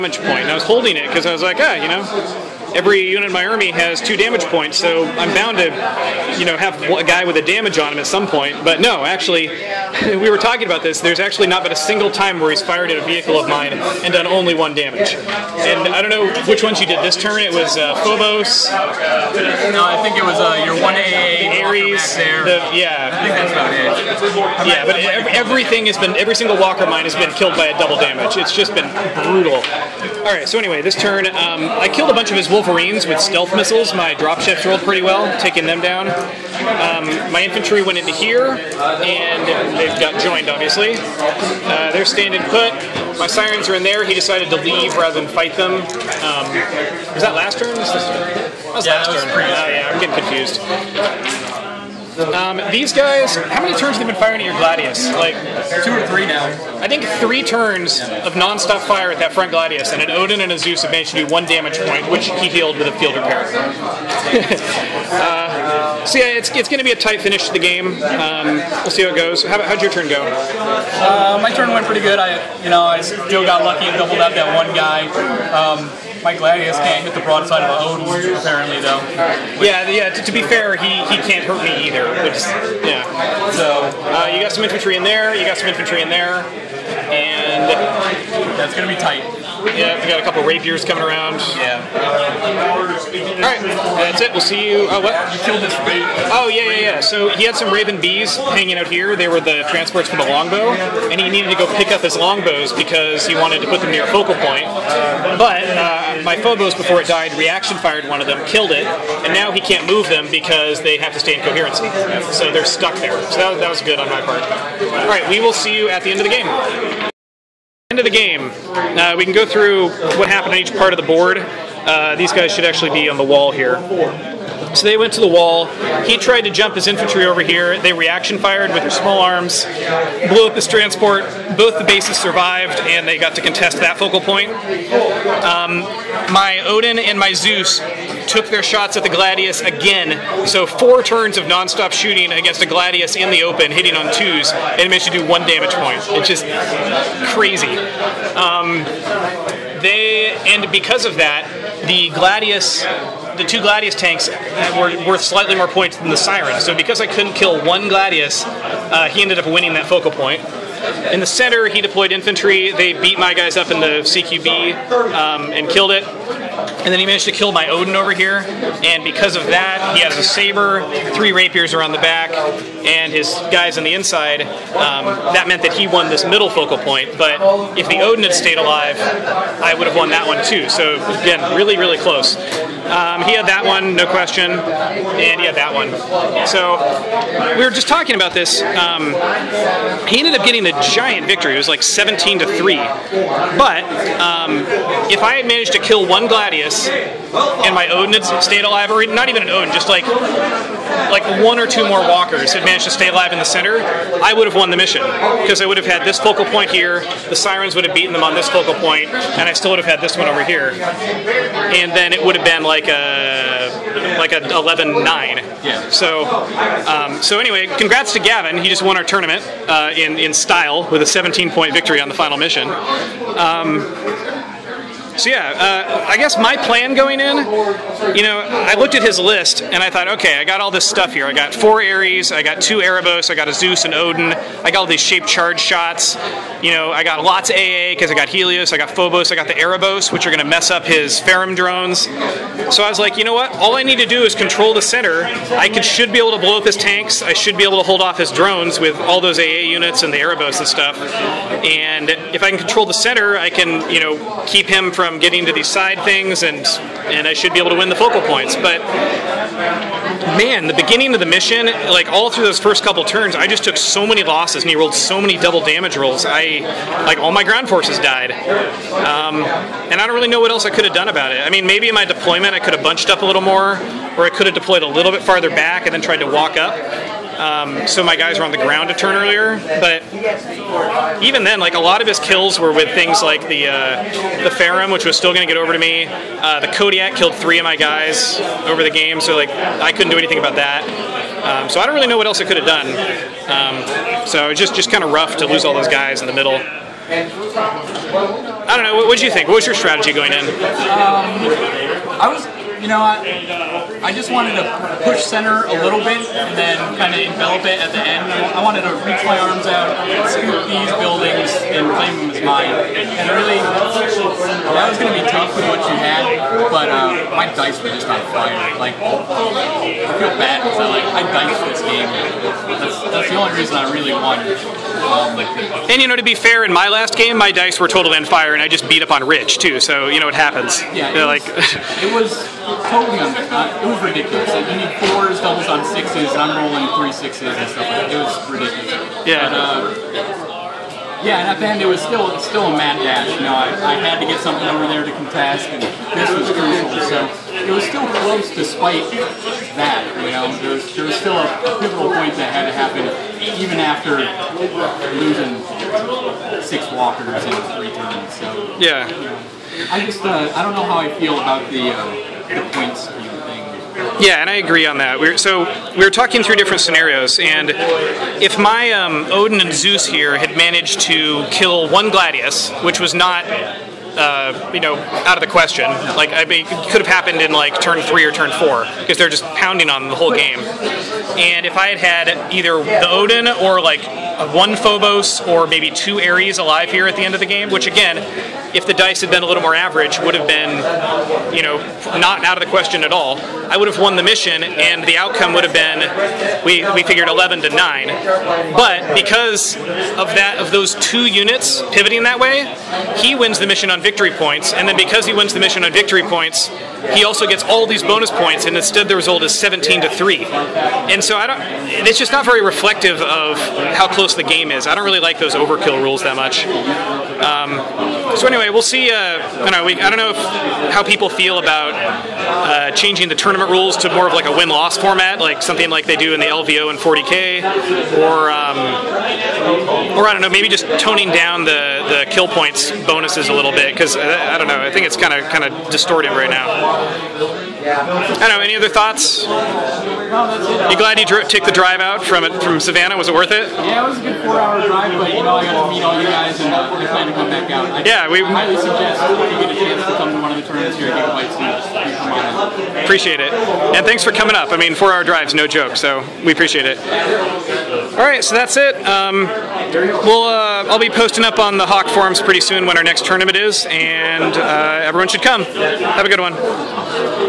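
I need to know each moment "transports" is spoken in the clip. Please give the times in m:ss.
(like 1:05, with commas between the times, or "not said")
1:39, 2:10.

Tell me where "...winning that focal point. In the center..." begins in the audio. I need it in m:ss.
2:39.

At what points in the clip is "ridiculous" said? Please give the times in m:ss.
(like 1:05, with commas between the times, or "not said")
5:34, 5:38.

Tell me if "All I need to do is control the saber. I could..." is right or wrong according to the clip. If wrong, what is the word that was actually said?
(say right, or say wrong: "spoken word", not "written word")
wrong: "center", not "saber".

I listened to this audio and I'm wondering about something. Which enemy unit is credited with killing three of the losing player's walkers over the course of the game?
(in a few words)
Kodiak.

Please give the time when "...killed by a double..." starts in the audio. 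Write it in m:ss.
0:27.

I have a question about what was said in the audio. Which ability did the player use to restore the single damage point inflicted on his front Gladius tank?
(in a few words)
Field repair.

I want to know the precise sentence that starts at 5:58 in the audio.
So yeah, you know, I just uh, I don't know how I feel about the uh, the points.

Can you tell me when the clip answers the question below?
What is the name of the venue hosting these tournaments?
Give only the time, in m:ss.
7:31.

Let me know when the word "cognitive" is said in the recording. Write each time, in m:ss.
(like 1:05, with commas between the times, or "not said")
not said.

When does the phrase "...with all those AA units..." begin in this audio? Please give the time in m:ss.
4:08.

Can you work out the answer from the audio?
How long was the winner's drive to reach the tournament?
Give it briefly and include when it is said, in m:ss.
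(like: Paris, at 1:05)
4 hours, at 7:24.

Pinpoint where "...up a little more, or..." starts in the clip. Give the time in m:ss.
4:33.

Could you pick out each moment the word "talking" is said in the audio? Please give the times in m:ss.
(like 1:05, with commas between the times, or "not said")
0:10, 3:07, 6:06.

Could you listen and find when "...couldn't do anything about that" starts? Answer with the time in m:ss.
4:49.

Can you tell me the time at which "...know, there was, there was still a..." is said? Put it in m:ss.
5:50.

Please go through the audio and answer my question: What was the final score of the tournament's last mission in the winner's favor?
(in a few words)
17 to 3.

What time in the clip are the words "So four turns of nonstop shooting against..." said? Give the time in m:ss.
2:20.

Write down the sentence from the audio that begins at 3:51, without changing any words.
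I got four Ares, I got two Erebos, I got a Zeus and Odin.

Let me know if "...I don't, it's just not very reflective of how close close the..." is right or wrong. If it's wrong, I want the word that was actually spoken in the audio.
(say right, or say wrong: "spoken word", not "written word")
right.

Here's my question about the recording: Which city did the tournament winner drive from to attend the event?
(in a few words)
Savannah.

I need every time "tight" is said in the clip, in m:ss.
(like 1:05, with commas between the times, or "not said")
1:06, 1:28.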